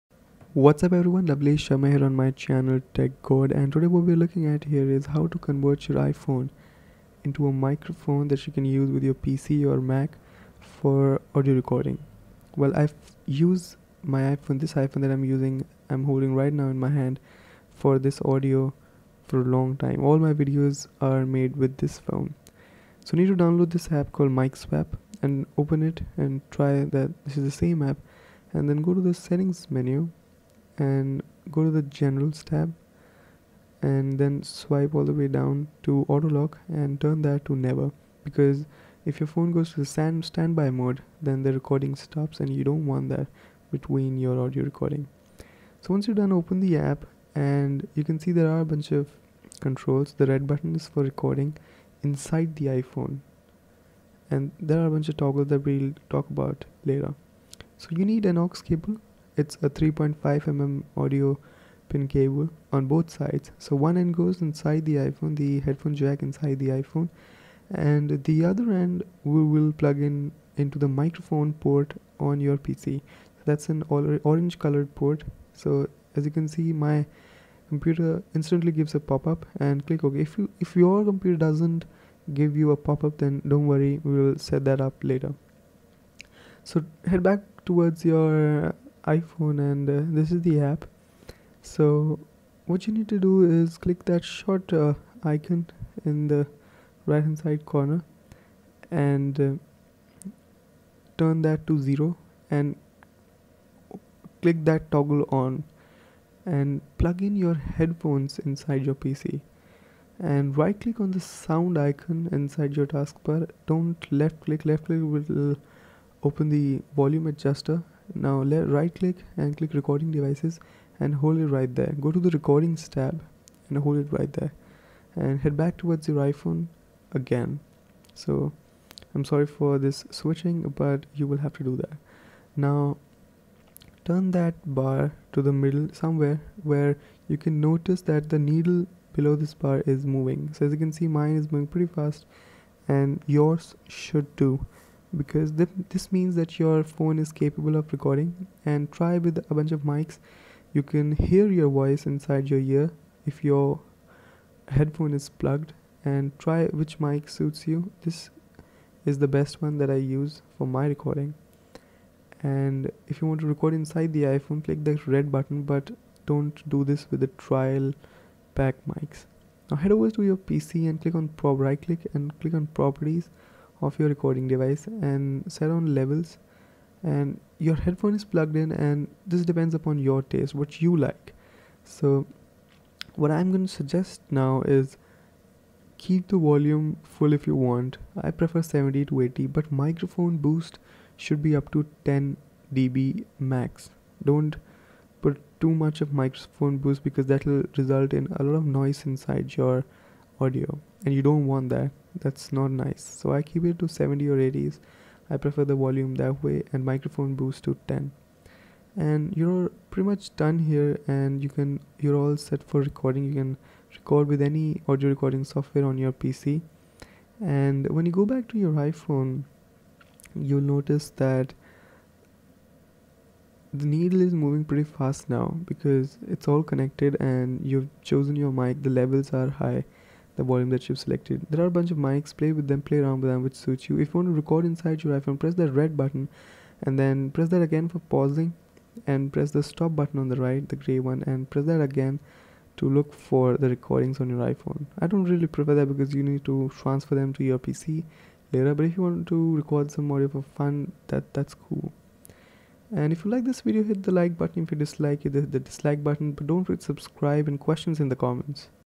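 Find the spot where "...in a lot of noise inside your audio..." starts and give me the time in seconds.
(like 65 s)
198 s.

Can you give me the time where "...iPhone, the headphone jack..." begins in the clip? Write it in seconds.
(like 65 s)
64 s.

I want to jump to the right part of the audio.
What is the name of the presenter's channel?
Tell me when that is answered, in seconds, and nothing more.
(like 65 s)
2 s.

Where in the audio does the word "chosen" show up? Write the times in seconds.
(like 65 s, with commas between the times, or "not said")
228 s.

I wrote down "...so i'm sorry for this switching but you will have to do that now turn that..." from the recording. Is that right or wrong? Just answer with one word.
right.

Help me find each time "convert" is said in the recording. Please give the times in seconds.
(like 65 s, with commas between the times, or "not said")
5 s.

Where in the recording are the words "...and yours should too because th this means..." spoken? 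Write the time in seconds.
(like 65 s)
142 s.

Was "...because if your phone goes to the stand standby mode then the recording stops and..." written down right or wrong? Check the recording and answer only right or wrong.
right.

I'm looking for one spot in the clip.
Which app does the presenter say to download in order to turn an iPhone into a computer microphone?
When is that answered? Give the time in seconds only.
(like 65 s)
24 s.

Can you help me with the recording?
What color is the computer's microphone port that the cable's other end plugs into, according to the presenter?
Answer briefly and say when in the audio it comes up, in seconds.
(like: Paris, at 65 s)
Orange, at 74 s.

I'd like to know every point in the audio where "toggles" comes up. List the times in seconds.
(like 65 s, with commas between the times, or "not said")
55 s, 104 s.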